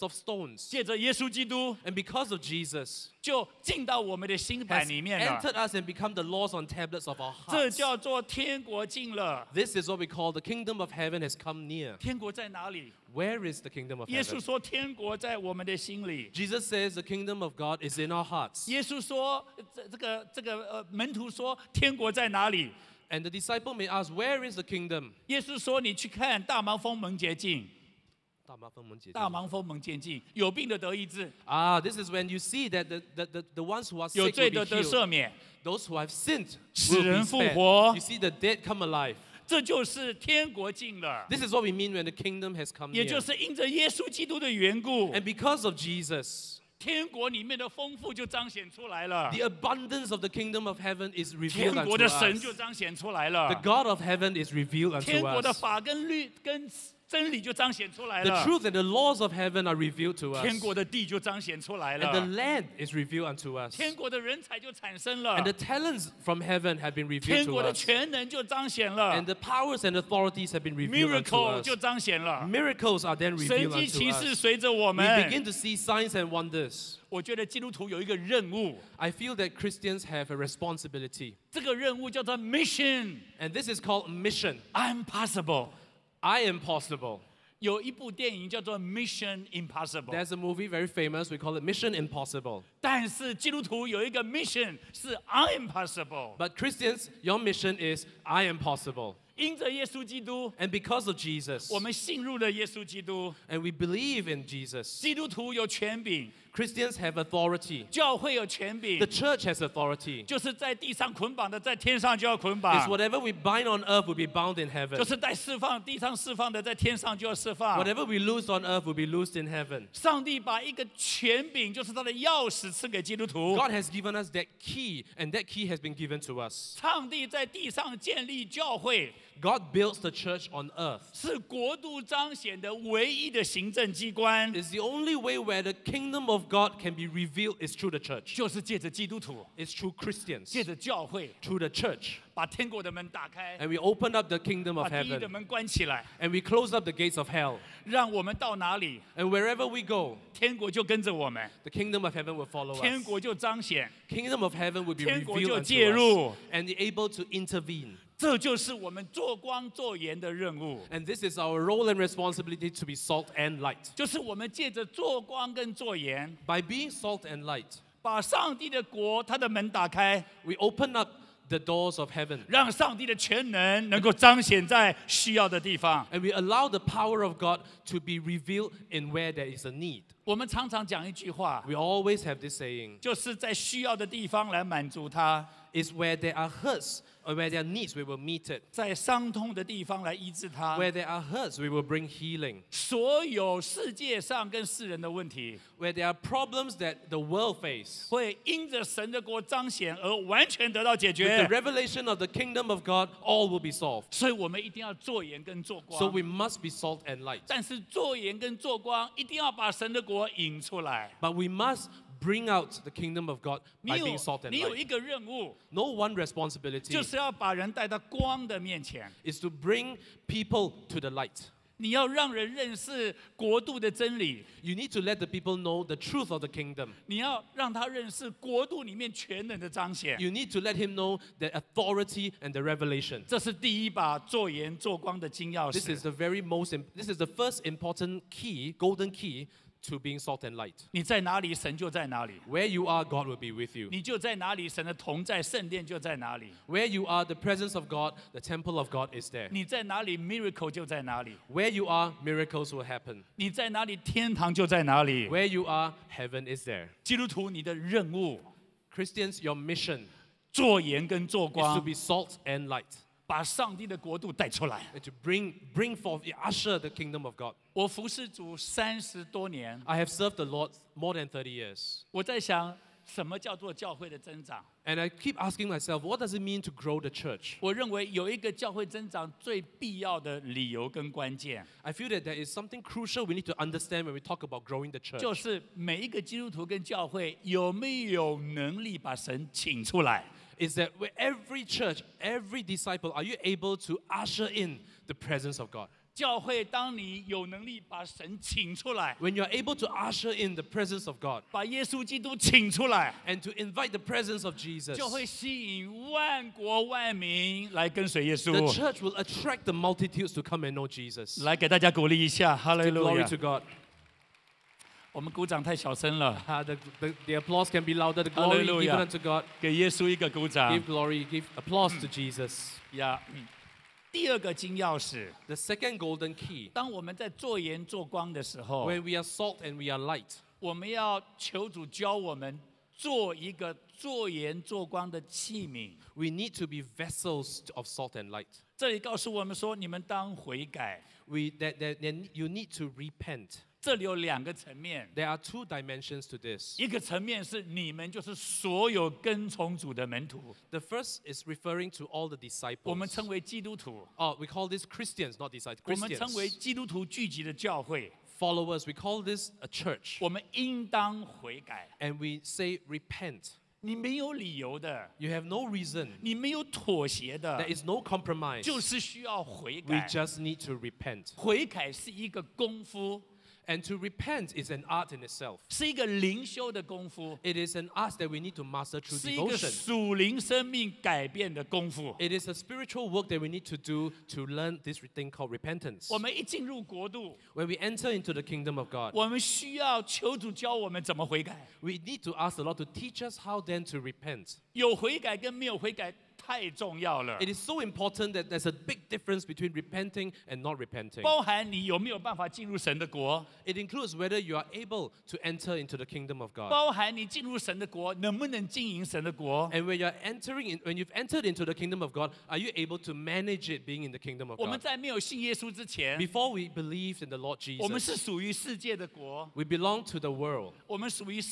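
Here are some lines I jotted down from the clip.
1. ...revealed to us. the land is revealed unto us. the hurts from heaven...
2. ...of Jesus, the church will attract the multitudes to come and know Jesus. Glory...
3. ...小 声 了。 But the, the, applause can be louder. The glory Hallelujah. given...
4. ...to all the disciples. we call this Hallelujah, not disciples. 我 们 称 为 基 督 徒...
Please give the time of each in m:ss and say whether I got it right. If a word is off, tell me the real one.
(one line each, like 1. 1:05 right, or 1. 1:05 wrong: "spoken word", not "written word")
1. 0:59 wrong: "talents", not "hurts"
2. 5:04 right
3. 5:15 wrong: "The", not "But"
4. 5:51 wrong: "Christians", not "Hallelujah".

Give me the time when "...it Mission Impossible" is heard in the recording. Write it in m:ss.
1:31.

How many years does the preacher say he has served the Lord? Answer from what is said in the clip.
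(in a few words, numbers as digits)
more than 30 years.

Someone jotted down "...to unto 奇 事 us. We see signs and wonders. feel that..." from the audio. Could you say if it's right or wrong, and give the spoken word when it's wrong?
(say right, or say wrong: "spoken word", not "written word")
right.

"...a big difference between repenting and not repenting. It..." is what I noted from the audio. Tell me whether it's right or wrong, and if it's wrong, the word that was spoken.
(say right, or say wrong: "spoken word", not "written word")
right.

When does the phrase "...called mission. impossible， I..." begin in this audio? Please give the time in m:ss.
1:23.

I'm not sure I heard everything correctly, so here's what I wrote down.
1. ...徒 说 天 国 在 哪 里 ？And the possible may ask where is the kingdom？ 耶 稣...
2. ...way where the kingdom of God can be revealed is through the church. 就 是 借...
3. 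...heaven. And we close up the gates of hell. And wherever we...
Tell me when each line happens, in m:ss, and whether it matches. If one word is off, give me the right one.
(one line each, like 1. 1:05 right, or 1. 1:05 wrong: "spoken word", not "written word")
1. 0:21 wrong: "disciple", not "possible"
2. 2:15 right
3. 2:24 right.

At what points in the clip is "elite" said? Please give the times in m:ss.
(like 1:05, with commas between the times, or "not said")
not said.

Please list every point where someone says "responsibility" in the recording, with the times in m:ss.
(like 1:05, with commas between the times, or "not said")
1:20, 2:41, 3:36.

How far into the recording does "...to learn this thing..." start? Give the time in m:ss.
6:24.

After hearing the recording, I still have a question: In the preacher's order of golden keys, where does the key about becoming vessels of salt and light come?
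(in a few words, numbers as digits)
second.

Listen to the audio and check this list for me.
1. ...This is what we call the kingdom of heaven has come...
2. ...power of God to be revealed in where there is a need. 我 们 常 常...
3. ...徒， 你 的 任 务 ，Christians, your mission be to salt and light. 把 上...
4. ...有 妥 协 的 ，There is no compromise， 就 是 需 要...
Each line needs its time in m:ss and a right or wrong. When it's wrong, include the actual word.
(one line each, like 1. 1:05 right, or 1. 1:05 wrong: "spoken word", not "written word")
1. 0:09 right
2. 2:56 right
3. 4:17 right
4. 6:06 right.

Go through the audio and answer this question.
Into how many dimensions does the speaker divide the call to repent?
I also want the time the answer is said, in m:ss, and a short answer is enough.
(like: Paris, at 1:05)
2, at 5:45.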